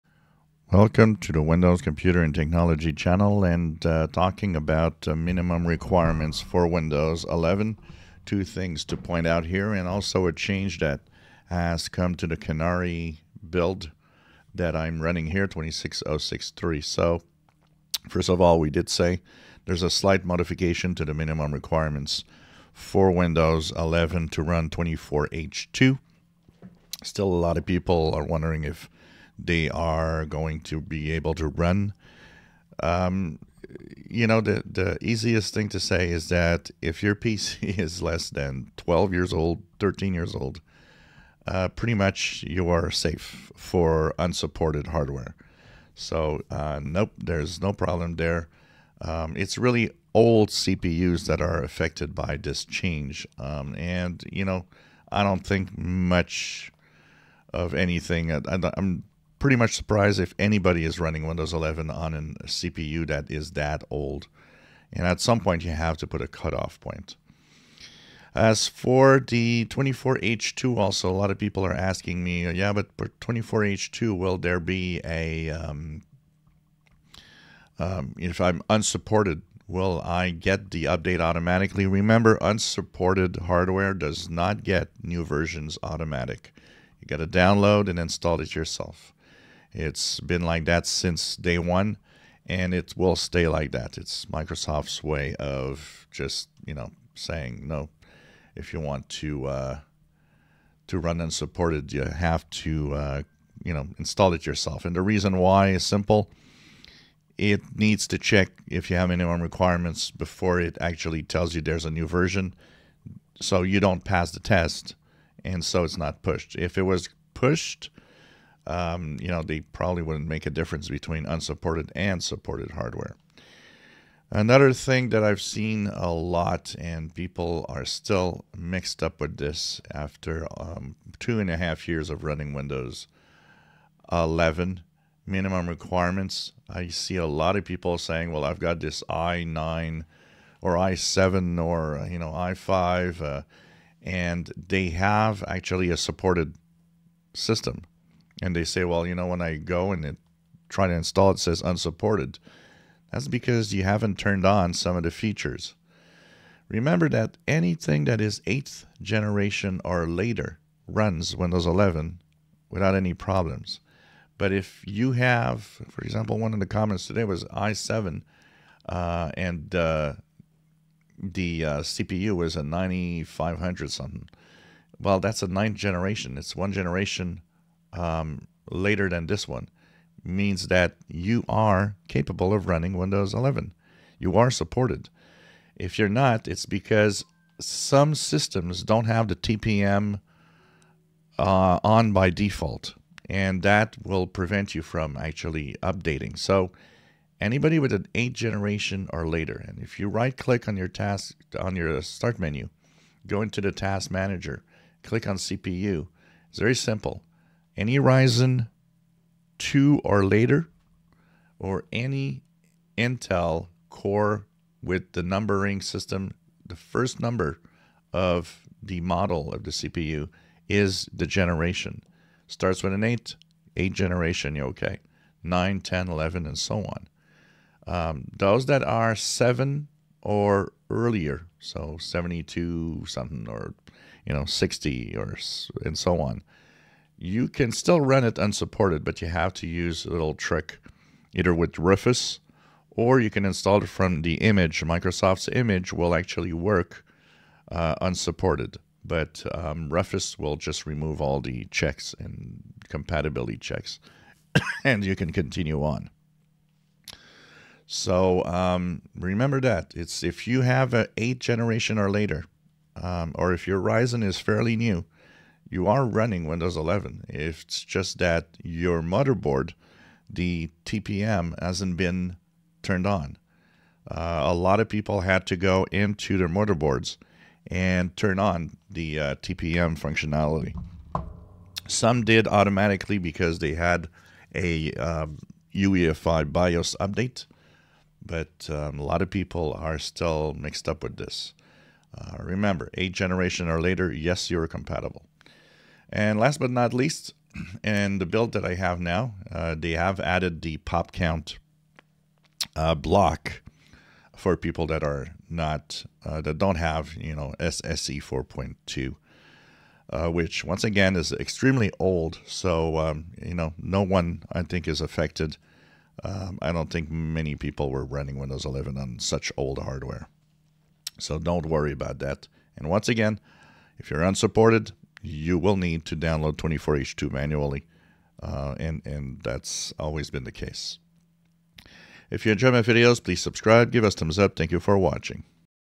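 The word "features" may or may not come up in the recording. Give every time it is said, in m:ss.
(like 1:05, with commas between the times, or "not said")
2:35.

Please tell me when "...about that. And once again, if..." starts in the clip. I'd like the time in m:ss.
5:21.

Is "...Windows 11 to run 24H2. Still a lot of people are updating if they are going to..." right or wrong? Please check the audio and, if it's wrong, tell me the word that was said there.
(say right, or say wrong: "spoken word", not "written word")
wrong: "wondering", not "updating".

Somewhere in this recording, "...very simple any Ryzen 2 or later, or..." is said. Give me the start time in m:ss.
3:26.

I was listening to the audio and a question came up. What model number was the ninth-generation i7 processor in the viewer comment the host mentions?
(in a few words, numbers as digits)
9500.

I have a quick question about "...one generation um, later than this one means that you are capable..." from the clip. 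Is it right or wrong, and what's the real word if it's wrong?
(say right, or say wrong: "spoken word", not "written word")
right.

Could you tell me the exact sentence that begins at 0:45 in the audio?
So, uh, nope, there's no problem there.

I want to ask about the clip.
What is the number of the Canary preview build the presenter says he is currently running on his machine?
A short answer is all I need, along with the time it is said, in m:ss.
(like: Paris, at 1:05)
26063, at 0:15.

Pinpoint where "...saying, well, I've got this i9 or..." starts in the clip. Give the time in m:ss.
2:17.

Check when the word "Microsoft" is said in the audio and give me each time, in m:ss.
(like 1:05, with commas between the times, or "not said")
1:34, 4:04.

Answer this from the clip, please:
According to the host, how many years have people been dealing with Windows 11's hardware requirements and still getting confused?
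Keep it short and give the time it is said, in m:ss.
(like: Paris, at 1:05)
2.5 years, at 2:11.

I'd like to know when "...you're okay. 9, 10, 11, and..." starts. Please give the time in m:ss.
3:44.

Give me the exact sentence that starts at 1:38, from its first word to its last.
If you want to uh, to run unsupported, you have to uh, you know install it yourself.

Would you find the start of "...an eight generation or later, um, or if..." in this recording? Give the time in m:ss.
4:20.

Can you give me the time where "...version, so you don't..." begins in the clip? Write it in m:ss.
1:52.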